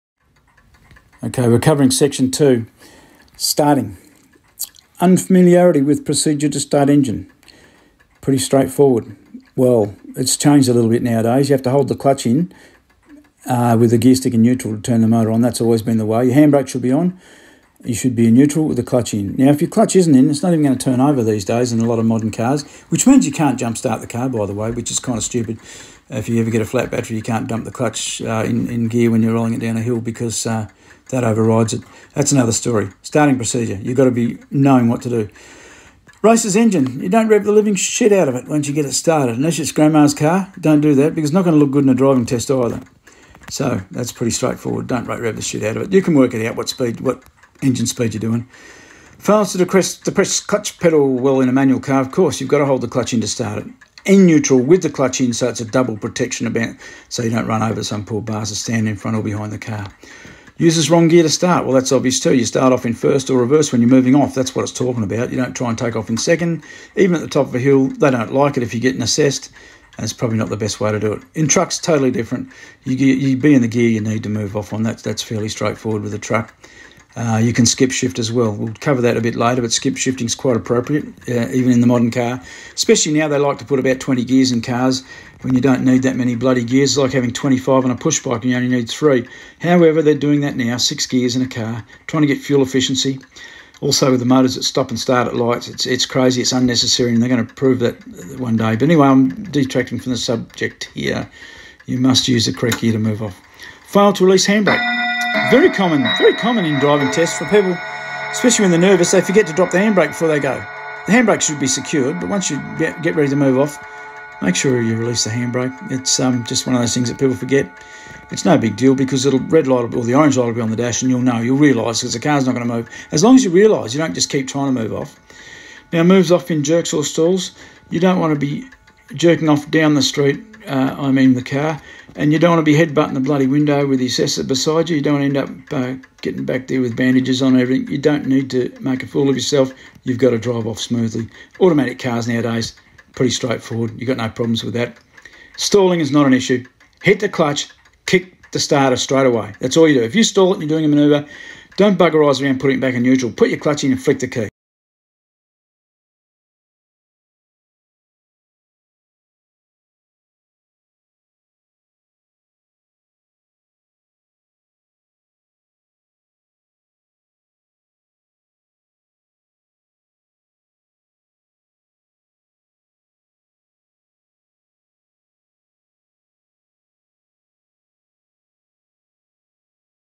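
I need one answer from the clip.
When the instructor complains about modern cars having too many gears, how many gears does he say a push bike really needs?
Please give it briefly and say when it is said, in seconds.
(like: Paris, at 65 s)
3, at 88 s.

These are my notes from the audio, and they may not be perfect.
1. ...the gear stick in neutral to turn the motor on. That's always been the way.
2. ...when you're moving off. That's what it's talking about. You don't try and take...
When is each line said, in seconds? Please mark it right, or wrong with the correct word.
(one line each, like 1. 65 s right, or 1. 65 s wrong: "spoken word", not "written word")
1. 13 s right
2. 63 s right.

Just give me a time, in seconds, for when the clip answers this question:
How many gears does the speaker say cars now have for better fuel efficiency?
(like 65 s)
90 s.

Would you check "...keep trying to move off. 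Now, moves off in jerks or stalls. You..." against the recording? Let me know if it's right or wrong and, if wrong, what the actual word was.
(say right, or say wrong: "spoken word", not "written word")
right.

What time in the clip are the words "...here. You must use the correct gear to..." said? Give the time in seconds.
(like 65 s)
100 s.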